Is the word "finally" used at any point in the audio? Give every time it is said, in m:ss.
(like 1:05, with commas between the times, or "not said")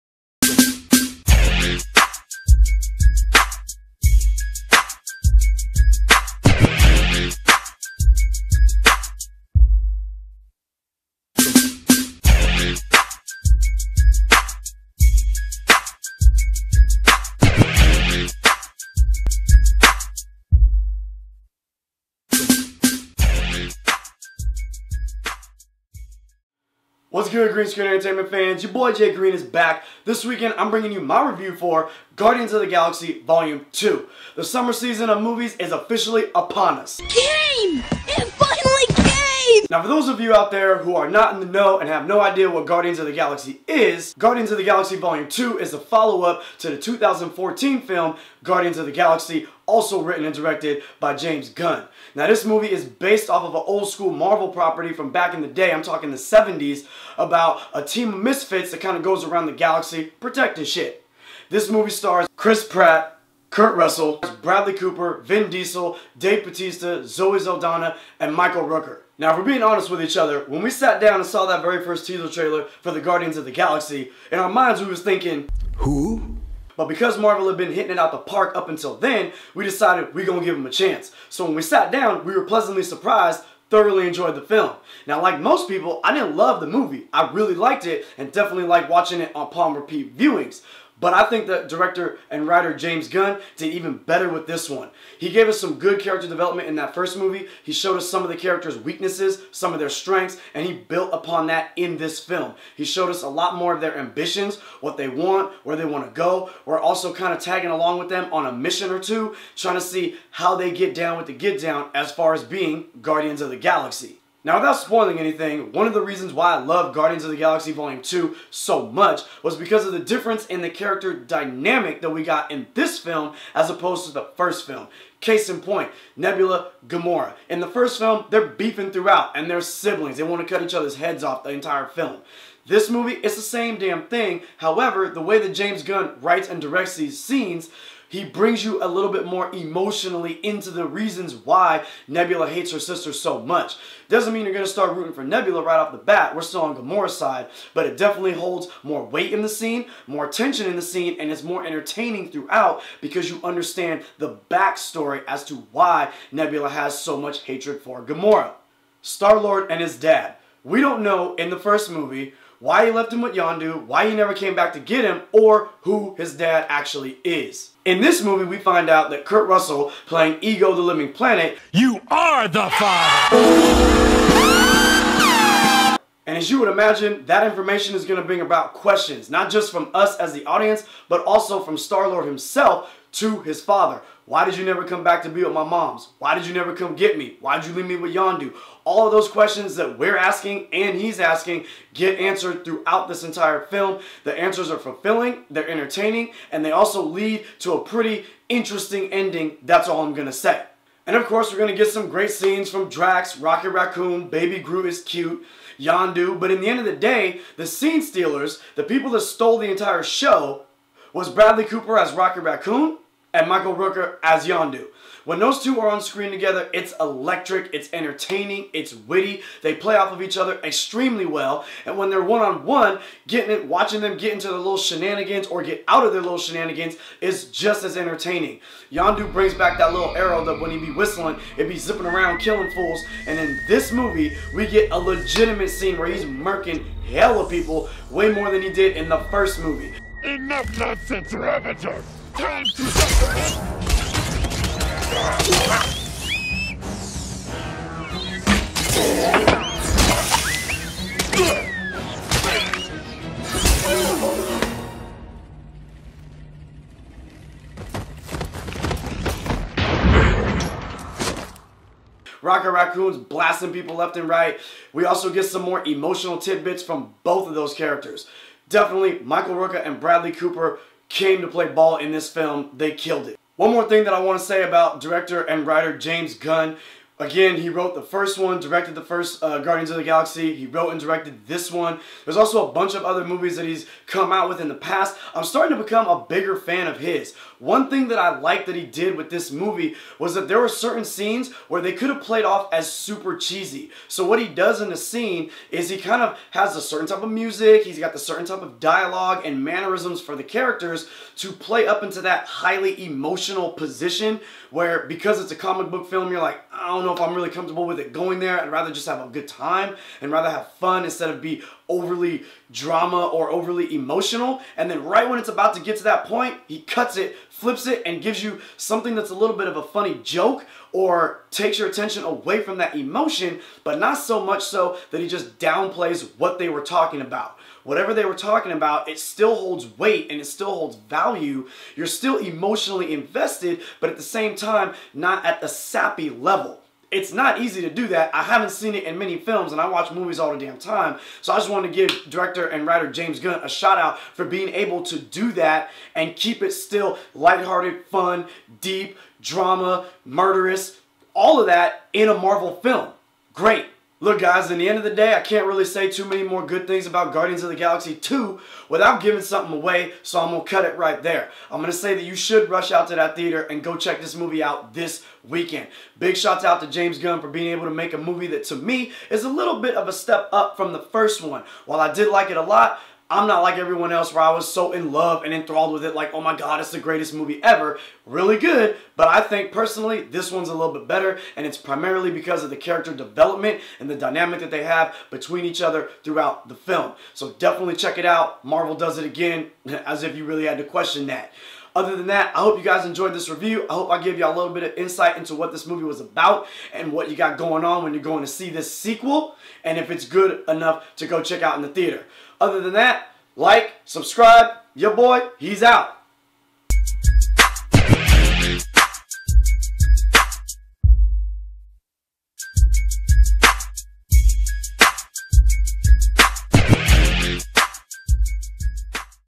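0:38.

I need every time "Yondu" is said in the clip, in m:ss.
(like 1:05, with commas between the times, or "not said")
2:43, 3:08, 3:25, 3:34, 3:48.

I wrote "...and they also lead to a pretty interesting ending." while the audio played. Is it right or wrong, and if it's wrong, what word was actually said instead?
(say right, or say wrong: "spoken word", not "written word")
right.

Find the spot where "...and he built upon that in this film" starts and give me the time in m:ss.
1:40.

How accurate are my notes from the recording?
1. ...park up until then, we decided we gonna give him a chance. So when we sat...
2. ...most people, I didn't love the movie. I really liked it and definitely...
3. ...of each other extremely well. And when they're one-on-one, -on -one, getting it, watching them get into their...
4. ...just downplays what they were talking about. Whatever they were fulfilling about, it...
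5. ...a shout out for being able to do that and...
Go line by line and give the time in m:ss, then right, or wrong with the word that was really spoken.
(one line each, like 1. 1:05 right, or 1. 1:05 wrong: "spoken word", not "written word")
1. 1:18 right
2. 1:25 right
3. 3:40 right
4. 5:25 wrong: "talking", not "fulfilling"
5. 5:43 right.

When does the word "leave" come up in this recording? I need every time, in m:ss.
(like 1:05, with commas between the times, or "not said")
3:07.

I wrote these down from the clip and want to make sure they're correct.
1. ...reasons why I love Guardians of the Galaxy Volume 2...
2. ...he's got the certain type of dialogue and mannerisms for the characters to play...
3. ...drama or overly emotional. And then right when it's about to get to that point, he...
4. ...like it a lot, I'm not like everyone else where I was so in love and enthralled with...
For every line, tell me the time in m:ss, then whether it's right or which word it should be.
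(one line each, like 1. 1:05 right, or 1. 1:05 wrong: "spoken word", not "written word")
1. 1:56 right
2. 4:57 right
3. 5:12 right
4. 6:12 right.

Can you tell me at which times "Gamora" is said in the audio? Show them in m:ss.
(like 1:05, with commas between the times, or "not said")
2:06, 2:26, 2:38.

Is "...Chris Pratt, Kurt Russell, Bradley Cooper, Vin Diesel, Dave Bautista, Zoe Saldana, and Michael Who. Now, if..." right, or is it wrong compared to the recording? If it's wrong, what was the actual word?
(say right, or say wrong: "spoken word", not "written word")
wrong: "Rooker", not "Who".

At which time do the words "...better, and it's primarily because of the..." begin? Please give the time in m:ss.
6:21.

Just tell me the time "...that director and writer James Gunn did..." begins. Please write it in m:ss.
1:31.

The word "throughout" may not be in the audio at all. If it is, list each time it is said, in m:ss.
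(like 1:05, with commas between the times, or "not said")
2:08, 2:32, 3:12, 6:26.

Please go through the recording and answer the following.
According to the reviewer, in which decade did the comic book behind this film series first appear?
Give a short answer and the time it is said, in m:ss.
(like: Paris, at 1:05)
The 70s, at 0:56.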